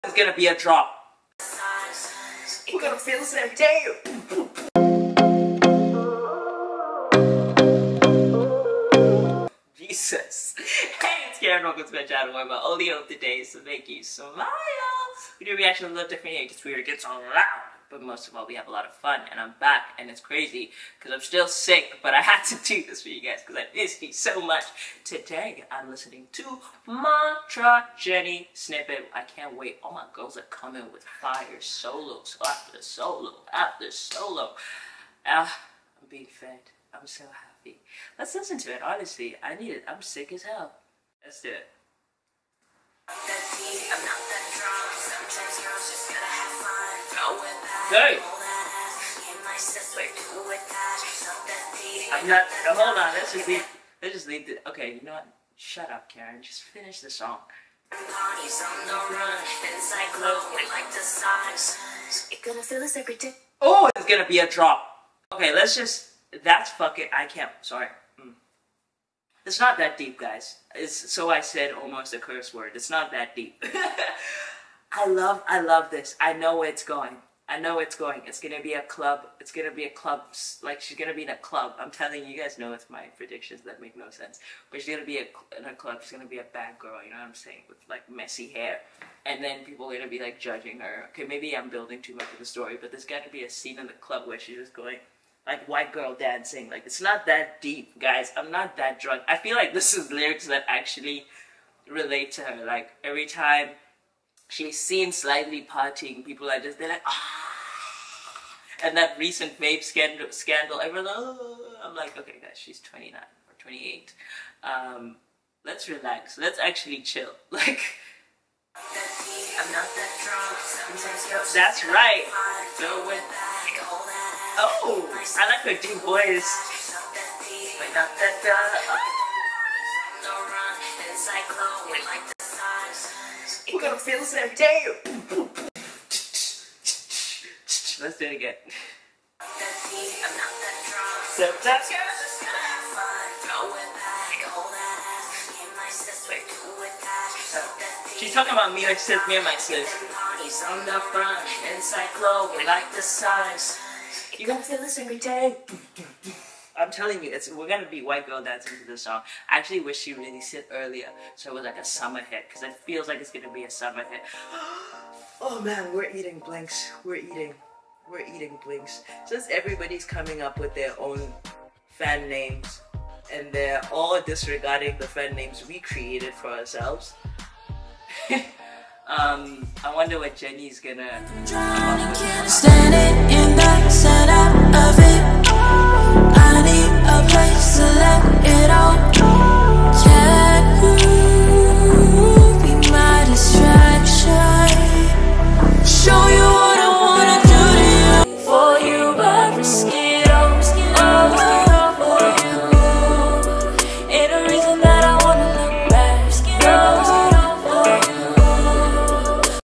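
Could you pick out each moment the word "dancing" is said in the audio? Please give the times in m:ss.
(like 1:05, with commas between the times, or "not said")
1:36, 2:38.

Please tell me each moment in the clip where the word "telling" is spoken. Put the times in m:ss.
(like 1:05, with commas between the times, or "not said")
1:21, 2:36.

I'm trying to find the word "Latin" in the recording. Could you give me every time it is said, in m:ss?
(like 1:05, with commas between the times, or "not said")
not said.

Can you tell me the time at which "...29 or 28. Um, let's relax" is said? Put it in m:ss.
1:52.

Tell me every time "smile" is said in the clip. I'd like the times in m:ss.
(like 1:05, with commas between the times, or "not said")
0:14.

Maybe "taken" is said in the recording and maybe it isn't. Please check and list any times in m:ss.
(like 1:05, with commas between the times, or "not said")
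not said.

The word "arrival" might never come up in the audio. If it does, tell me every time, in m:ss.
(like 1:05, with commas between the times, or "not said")
not said.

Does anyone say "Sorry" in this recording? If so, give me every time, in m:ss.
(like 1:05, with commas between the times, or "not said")
1:07.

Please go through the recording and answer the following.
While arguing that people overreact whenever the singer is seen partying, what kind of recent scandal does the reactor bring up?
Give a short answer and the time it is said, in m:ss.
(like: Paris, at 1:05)
vape scandal, at 1:49.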